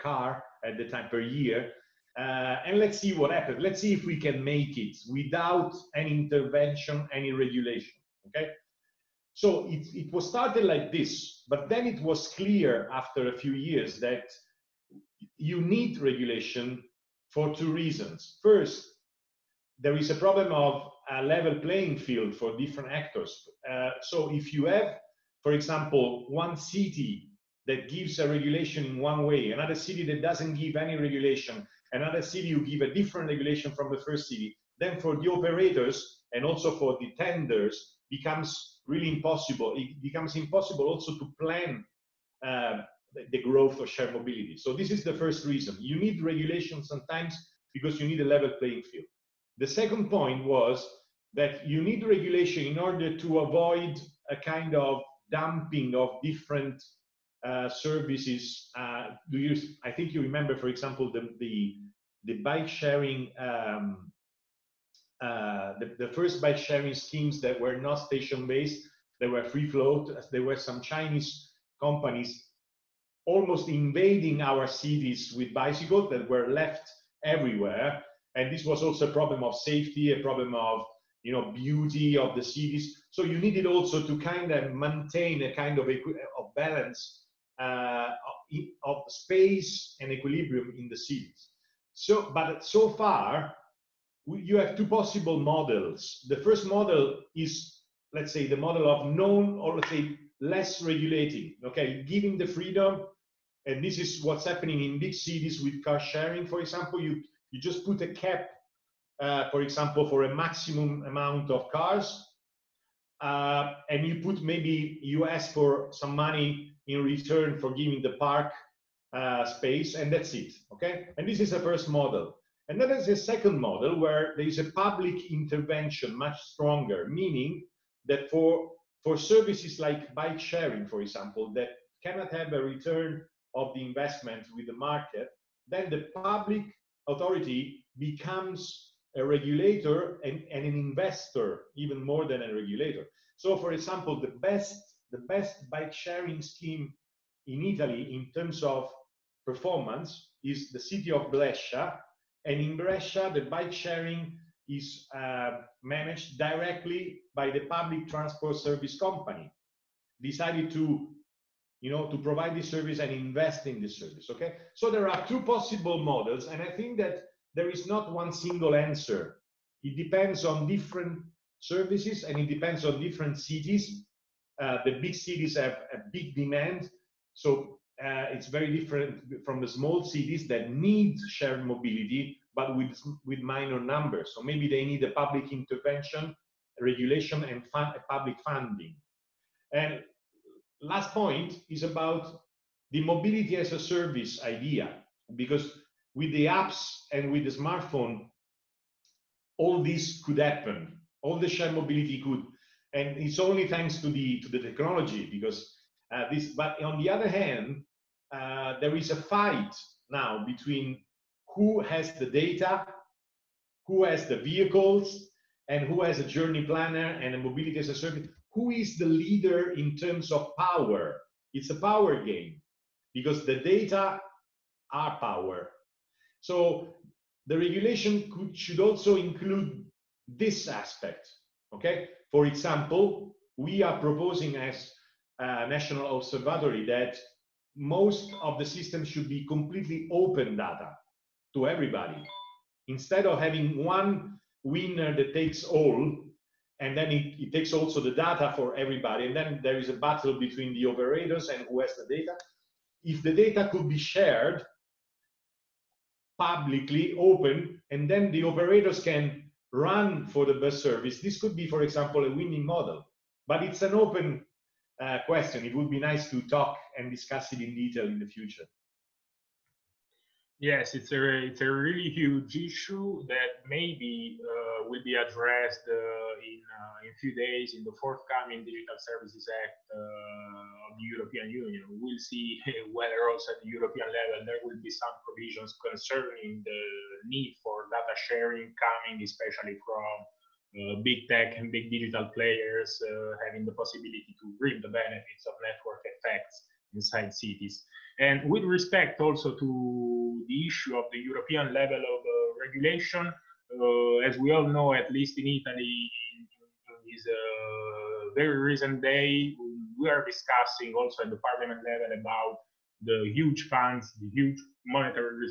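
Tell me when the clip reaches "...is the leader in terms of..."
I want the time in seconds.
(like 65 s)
218 s.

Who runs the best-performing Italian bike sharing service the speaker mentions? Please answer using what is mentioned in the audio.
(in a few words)
The public transport service company.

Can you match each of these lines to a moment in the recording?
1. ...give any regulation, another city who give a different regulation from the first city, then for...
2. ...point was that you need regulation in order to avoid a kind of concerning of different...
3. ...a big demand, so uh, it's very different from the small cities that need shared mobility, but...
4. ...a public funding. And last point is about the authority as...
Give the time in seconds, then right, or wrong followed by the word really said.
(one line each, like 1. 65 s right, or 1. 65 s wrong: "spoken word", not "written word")
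1. 30 s right
2. 50 s wrong: "dumping", not "concerning"
3. 175 s right
4. 187 s wrong: "mobility", not "authority".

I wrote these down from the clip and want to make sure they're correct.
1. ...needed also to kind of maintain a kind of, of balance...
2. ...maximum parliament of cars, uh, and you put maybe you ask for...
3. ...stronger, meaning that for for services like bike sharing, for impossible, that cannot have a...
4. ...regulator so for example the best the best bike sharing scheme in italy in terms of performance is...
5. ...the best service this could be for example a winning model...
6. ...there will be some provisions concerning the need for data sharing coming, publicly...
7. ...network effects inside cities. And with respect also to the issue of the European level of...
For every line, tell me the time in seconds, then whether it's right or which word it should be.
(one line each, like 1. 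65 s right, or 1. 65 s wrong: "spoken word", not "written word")
1. 83 s right
2. 110 s wrong: "amount", not "parliament"
3. 126 s wrong: "example", not "impossible"
4. 142 s right
5. 260 s right
6. 284 s wrong: "especially", not "publicly"
7. 295 s right.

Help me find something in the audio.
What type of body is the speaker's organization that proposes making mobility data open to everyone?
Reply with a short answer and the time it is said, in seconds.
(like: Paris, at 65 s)
National observatory, at 235 s.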